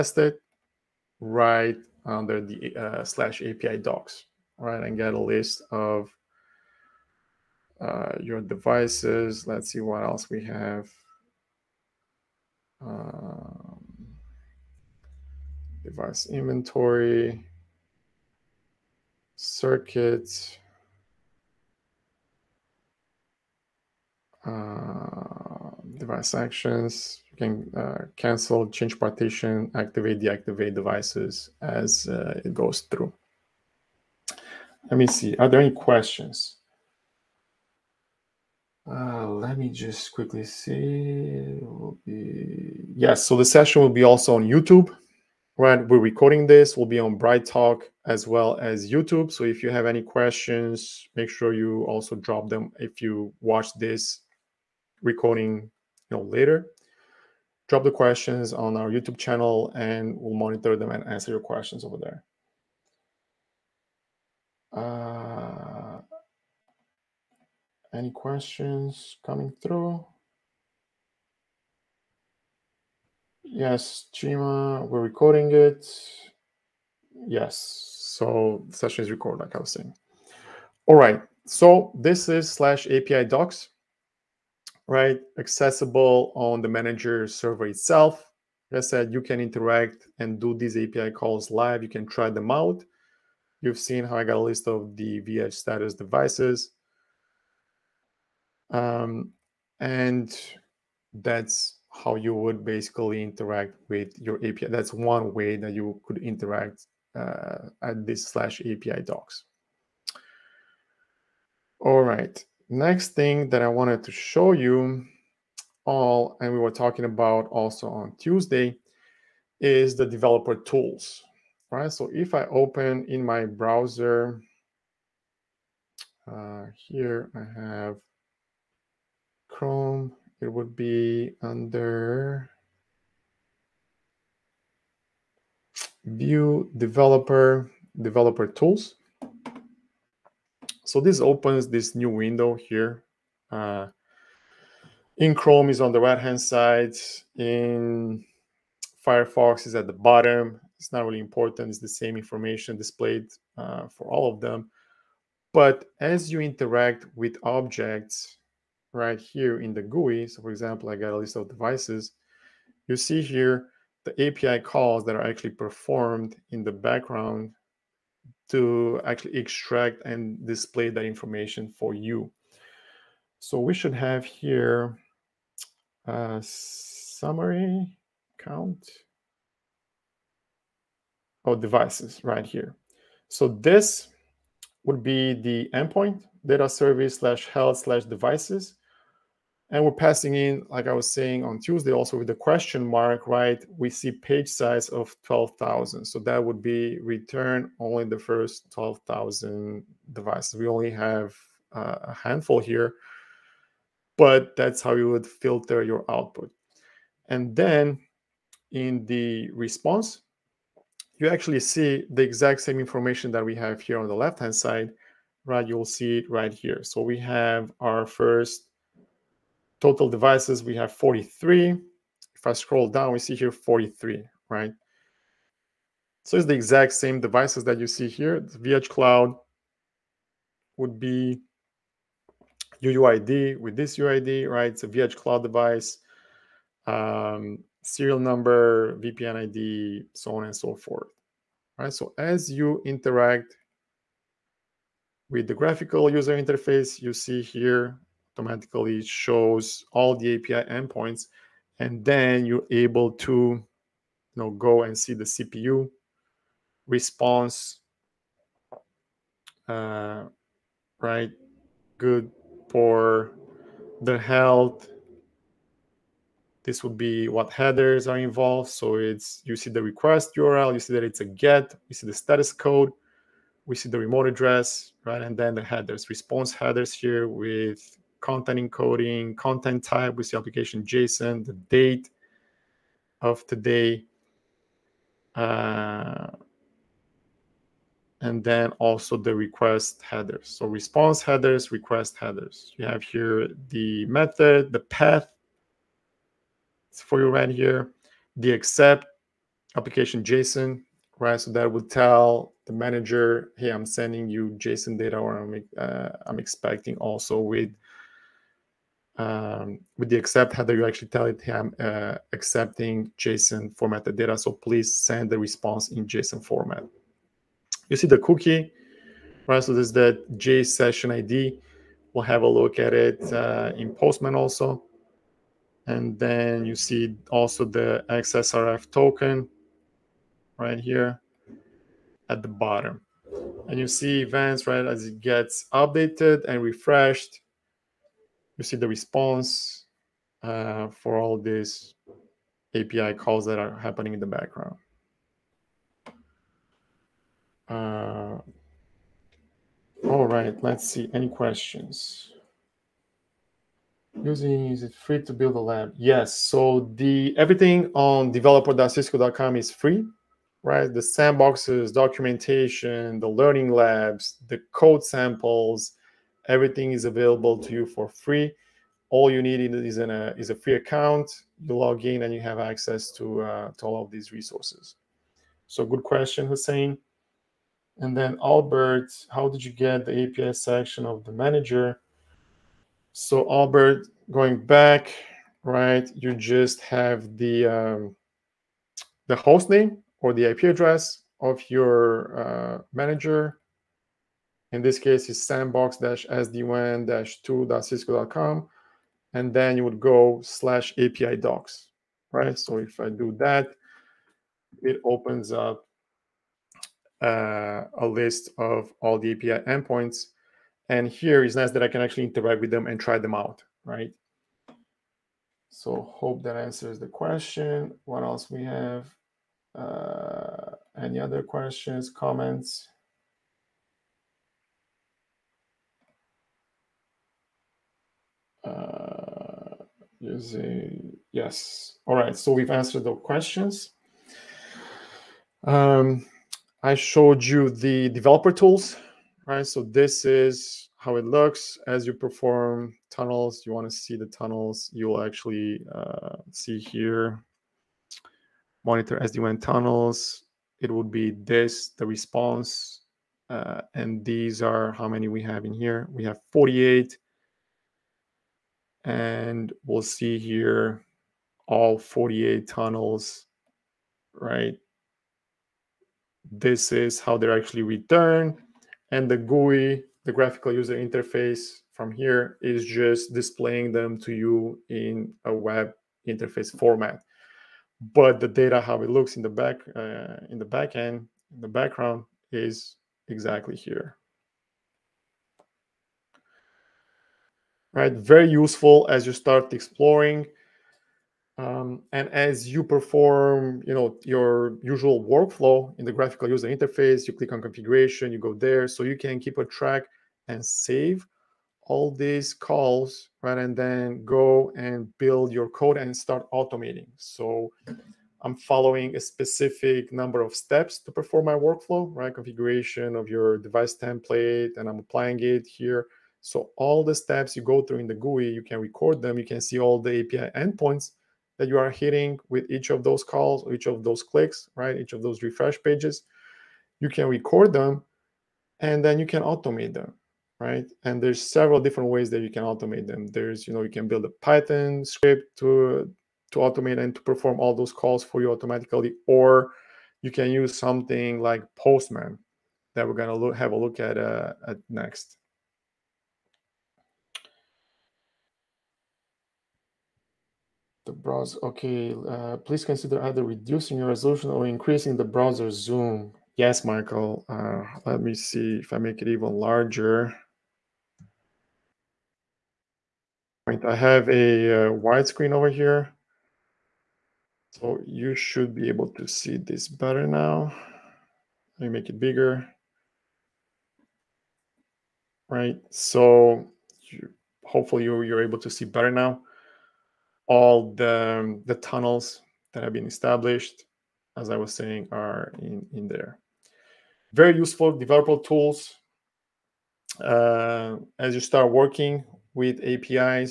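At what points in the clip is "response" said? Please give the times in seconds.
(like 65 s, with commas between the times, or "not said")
209 s, 256 s, 276 s, 290 s, 315 s, 338 s, 452 s.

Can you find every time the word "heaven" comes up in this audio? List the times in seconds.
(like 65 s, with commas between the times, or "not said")
not said.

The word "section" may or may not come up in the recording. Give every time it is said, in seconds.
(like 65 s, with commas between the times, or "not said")
380 s.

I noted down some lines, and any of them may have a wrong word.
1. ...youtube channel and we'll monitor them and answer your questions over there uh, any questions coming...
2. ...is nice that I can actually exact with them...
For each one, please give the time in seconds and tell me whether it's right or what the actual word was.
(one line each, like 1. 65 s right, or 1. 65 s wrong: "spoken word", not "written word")
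1. 58 s right
2. 411 s wrong: "interact", not "exact".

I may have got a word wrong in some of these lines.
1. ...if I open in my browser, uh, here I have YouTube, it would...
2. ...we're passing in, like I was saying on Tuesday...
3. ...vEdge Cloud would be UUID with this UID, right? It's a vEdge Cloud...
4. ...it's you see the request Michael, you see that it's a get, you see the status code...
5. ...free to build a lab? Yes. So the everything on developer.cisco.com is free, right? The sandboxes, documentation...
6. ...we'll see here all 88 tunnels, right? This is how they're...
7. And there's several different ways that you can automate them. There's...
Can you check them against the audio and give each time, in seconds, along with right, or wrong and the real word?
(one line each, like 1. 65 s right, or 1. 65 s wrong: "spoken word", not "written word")
1. 122 s wrong: "Chrome", not "YouTube"
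2. 189 s right
3. 228 s right
4. 268 s wrong: "URL", not "Michael"
5. 354 s right
6. 459 s wrong: "48", not "88"
7. 531 s right.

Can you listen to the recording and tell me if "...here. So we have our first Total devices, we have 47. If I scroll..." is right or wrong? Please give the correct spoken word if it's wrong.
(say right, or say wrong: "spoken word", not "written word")
wrong: "43", not "47".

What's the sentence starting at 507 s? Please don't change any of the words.
So I'm following a specific number of steps to perform my workflow, right?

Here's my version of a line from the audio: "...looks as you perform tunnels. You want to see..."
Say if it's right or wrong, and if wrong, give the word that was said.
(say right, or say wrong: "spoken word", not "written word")
right.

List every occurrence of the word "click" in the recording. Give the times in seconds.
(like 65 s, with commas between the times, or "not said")
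497 s, 524 s.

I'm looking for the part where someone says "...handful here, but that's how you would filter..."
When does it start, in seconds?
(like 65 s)
202 s.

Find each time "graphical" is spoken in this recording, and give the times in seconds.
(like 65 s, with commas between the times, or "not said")
245 s, 470 s, 496 s.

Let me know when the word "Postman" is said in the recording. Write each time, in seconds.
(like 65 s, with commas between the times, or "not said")
323 s, 541 s.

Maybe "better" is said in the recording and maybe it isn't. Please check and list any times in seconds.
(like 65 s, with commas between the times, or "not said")
569 s, 578 s.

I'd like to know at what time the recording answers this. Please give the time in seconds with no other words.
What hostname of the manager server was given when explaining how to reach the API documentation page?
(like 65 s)
395 s.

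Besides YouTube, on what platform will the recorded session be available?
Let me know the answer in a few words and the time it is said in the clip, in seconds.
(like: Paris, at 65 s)
BrightTALK, at 47 s.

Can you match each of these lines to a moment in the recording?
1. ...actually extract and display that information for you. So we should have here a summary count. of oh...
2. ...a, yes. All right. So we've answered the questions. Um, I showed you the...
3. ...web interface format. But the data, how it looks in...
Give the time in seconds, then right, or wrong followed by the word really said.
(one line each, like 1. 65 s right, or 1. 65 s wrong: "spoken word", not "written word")
1. 169 s right
2. 430 s right
3. 475 s right.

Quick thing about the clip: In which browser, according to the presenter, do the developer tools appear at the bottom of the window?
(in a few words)
Firefox.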